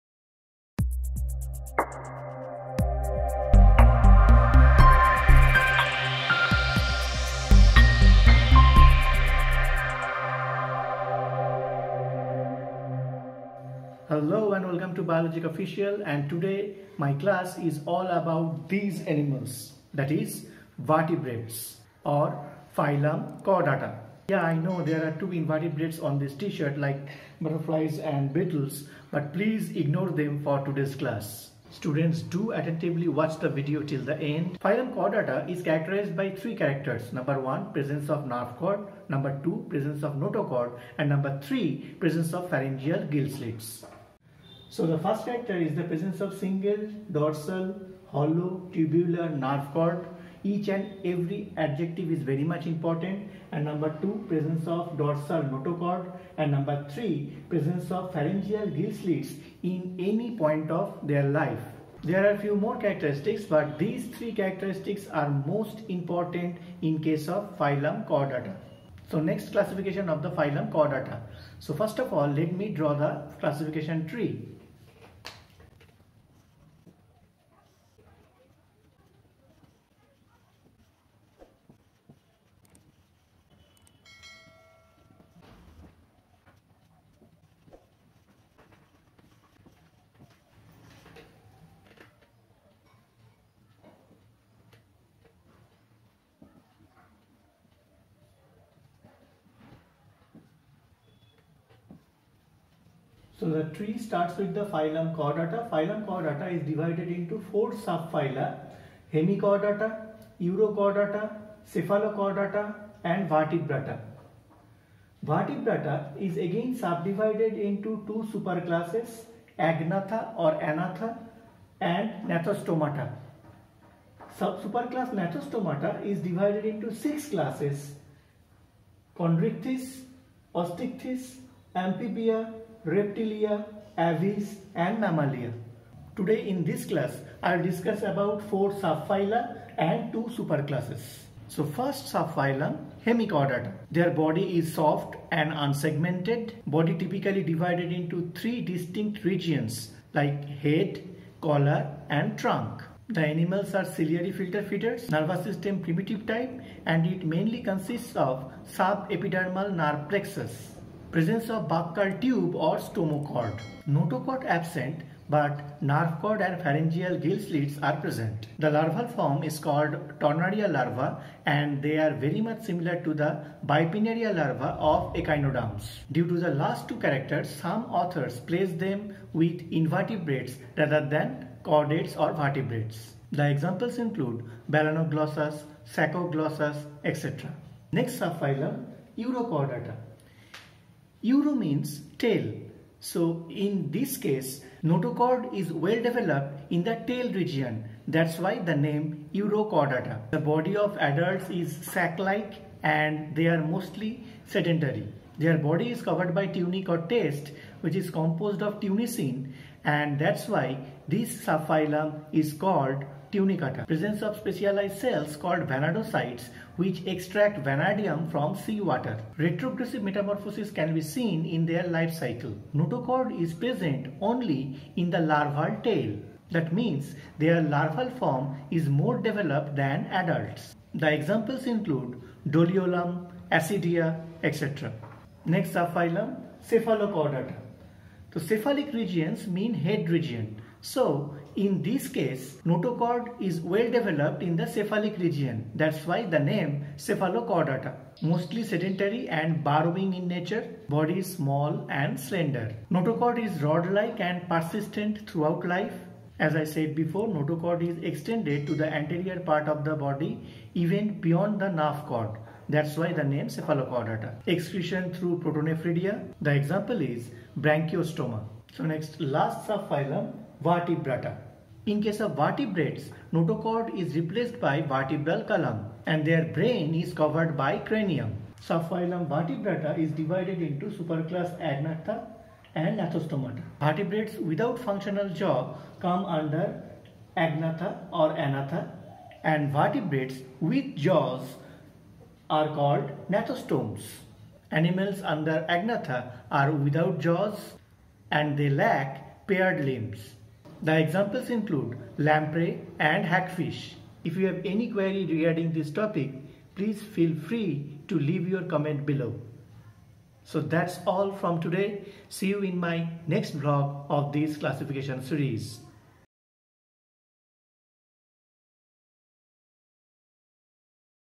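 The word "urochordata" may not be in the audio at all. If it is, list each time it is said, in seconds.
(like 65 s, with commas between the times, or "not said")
110 s, 189 s, 199 s.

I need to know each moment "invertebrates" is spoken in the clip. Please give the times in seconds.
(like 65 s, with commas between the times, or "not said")
25 s, 179 s.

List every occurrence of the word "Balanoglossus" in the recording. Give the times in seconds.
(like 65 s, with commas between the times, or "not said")
184 s.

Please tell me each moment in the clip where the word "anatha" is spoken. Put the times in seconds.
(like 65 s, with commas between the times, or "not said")
120 s, 288 s.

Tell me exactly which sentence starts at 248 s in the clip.
Mostly sedentary and burrowing in nature, body is small and slender.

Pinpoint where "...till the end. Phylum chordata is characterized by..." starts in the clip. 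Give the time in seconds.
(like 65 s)
33 s.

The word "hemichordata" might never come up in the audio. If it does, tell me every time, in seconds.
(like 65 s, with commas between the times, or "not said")
109 s, 143 s.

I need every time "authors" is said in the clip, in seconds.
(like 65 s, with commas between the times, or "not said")
178 s.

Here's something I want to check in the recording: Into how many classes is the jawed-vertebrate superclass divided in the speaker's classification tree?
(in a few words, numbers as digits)
6.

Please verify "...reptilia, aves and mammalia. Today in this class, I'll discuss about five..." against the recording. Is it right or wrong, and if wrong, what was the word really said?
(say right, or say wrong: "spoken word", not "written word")
wrong: "four", not "five".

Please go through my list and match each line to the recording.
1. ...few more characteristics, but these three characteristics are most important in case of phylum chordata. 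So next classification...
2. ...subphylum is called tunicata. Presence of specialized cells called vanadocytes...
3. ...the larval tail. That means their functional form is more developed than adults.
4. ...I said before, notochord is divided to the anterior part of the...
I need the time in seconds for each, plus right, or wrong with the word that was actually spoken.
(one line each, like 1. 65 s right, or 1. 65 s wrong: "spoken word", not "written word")
1. 62 s right
2. 211 s right
3. 225 s wrong: "larval", not "functional"
4. 256 s wrong: "extended", not "divided".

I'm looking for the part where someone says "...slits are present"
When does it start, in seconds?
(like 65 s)
167 s.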